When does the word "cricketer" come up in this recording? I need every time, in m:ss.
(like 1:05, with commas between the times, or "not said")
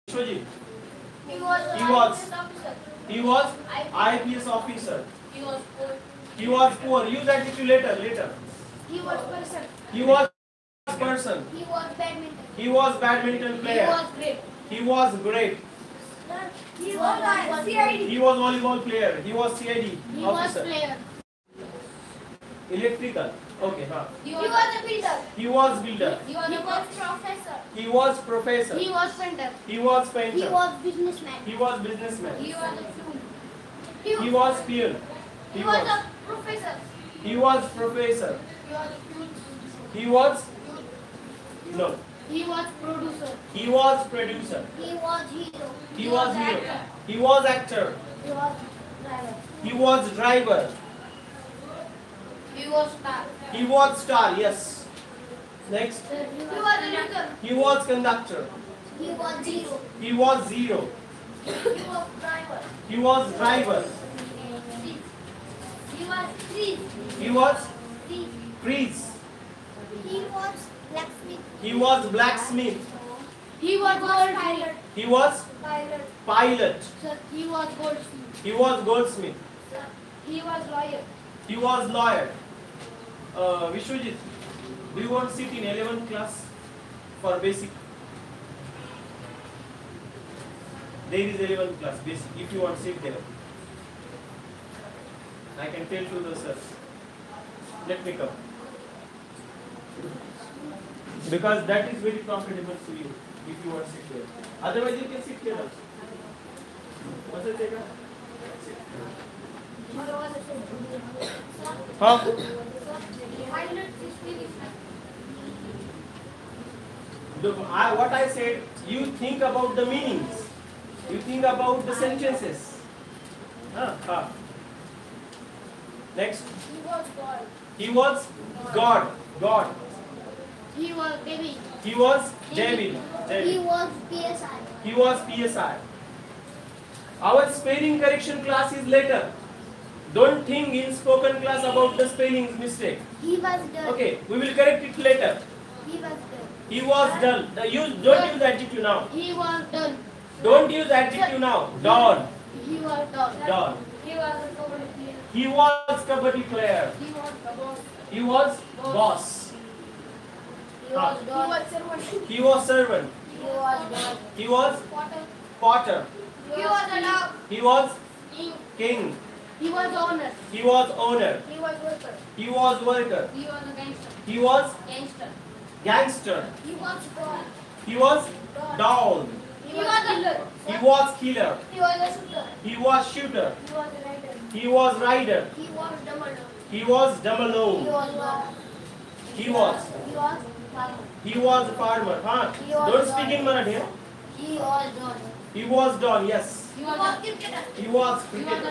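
3:17.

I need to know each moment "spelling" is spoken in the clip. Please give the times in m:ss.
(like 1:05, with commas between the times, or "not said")
2:17, 2:22.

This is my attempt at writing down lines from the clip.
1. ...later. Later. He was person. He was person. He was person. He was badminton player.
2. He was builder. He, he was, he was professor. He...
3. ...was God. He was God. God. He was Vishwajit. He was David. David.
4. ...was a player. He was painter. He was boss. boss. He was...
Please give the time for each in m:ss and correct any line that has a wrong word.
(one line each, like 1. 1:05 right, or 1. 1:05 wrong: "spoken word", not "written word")
1. 0:07 wrong: "badminton", not "person"
2. 0:25 right
3. 2:06 wrong: "David", not "Vishwajit"
4. 2:34 wrong: "player", not "painter".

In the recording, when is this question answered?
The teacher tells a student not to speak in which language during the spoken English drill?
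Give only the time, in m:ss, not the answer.
3:13.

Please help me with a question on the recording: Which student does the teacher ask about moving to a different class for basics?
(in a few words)
Vishwajit.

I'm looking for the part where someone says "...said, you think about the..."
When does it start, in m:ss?
1:58.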